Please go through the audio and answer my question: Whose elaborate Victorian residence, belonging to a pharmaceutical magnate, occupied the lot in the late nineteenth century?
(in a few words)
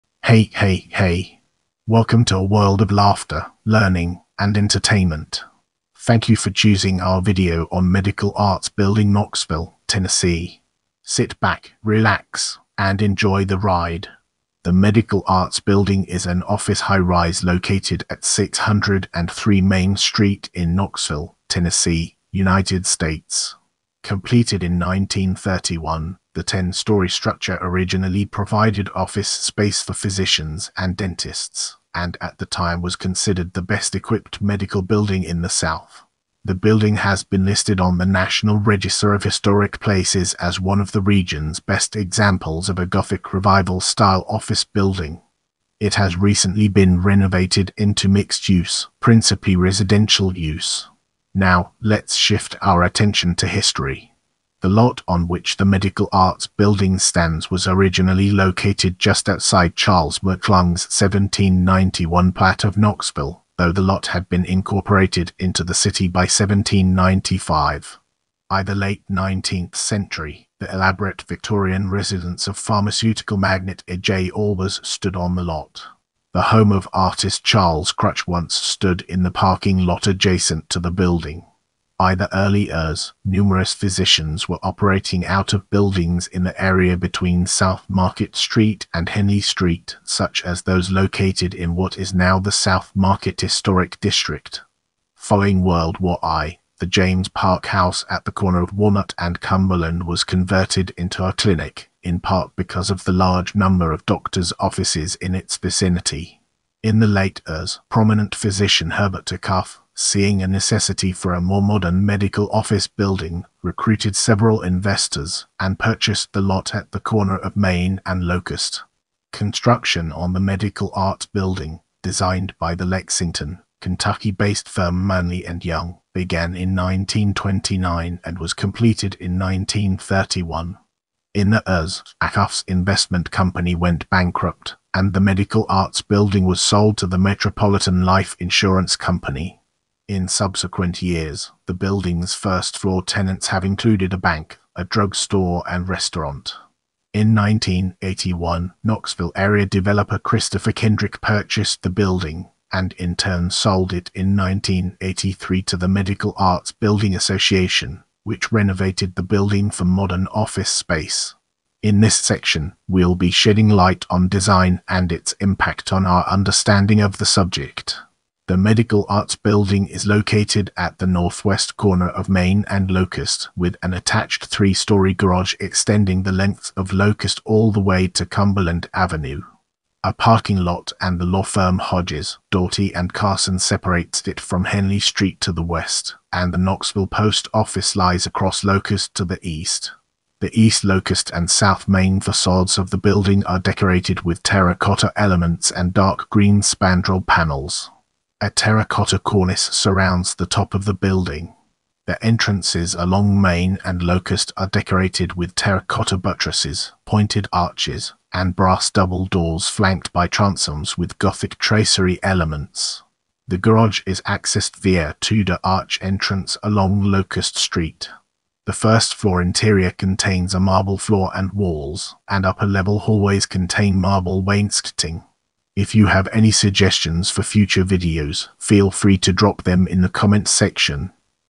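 A. J. Albers.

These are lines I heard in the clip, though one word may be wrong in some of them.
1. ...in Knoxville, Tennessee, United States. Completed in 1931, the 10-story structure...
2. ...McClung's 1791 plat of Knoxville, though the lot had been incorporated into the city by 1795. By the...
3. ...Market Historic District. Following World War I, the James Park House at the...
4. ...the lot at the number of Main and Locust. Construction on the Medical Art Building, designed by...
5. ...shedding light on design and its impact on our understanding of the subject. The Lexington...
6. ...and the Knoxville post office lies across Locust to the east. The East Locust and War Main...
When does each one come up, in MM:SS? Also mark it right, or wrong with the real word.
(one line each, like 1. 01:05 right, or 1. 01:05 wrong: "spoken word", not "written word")
1. 00:20 right
2. 01:00 right
3. 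01:32 right
4. 01:56 wrong: "corner", not "number"
5. 02:43 wrong: "Medical", not "Lexington"
6. 03:06 wrong: "South", not "War".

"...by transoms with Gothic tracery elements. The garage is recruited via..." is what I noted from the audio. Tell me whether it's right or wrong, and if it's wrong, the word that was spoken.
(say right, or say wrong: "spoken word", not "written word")
wrong: "accessed", not "recruited".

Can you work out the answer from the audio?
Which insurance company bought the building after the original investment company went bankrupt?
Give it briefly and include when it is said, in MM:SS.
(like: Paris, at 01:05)
Metropolitan Life Insurance Company, at 02:17.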